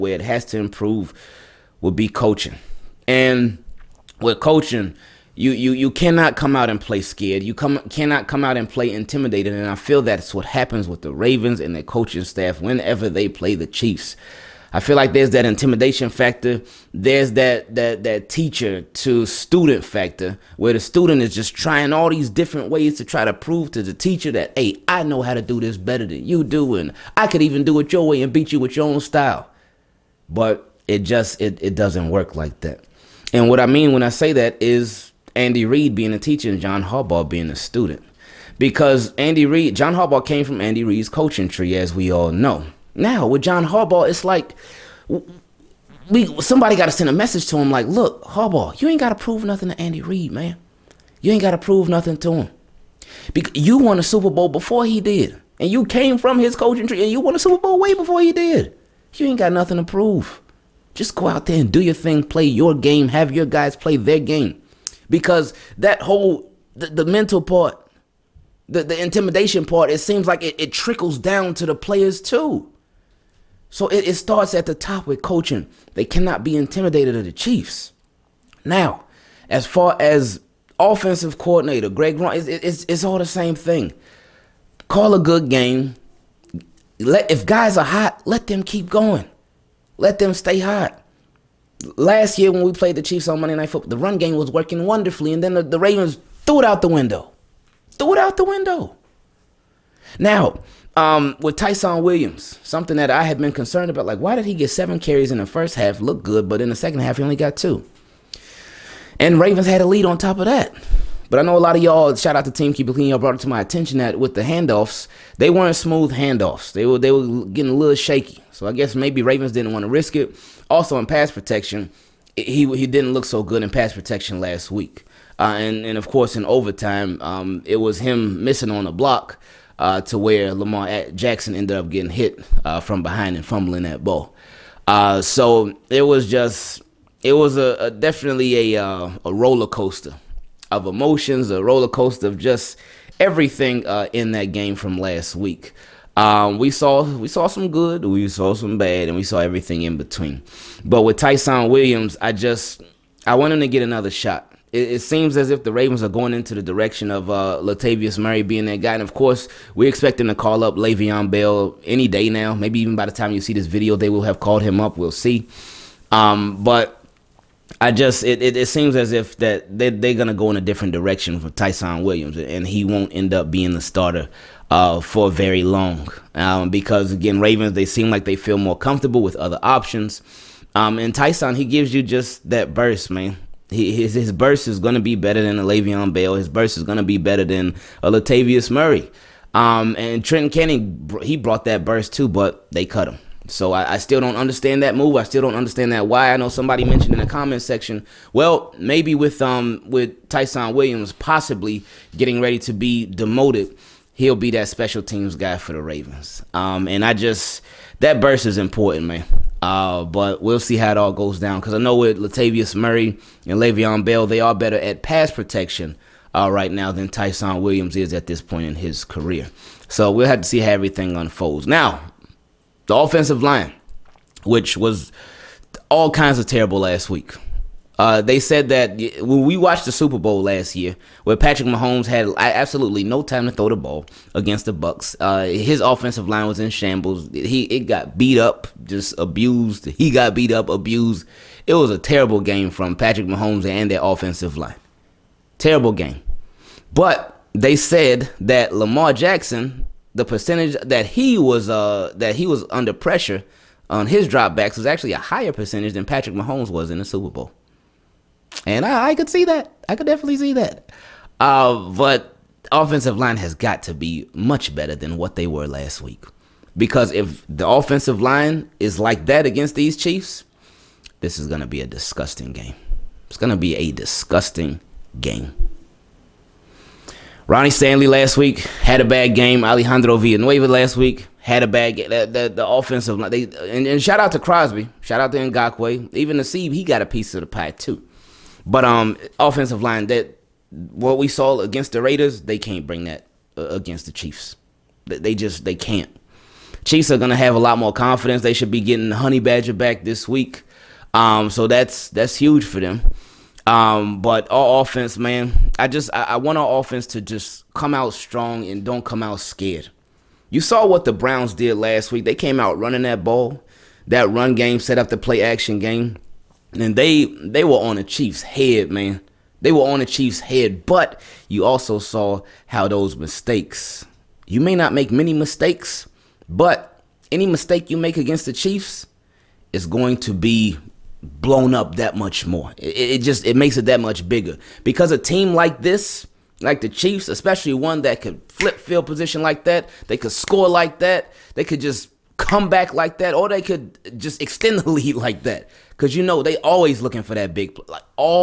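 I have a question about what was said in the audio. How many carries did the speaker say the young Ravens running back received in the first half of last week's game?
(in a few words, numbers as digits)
7.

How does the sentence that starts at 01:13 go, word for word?
So it, it starts at the top with coaching.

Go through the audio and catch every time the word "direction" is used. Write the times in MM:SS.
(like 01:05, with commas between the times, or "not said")
02:36, 02:50.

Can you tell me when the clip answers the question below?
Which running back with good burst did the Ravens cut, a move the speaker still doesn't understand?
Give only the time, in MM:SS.
03:10.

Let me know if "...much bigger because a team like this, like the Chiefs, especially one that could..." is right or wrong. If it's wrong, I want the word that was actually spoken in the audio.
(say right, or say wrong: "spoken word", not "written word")
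right.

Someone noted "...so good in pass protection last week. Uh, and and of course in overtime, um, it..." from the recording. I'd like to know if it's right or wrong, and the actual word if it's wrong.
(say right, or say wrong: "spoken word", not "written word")
right.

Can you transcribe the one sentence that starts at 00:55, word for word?
And you came from his coaching tree and you won a Super Bowl way before he did.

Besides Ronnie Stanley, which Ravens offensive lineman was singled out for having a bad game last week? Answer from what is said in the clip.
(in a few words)
Alejandro Villanueva.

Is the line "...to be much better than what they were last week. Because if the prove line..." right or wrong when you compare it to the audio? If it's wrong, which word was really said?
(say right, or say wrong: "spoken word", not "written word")
wrong: "offensive", not "prove".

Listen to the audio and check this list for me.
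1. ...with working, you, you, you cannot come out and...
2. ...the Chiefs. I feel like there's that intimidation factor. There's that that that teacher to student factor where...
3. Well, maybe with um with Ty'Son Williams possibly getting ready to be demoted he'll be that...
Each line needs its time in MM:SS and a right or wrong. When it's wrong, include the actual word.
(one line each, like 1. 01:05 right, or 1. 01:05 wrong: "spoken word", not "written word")
1. 00:04 wrong: "coaching", not "working"
2. 00:13 right
3. 03:18 right.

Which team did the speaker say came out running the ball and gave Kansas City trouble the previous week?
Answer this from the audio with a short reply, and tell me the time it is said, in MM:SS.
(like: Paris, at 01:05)
Browns, at 05:11.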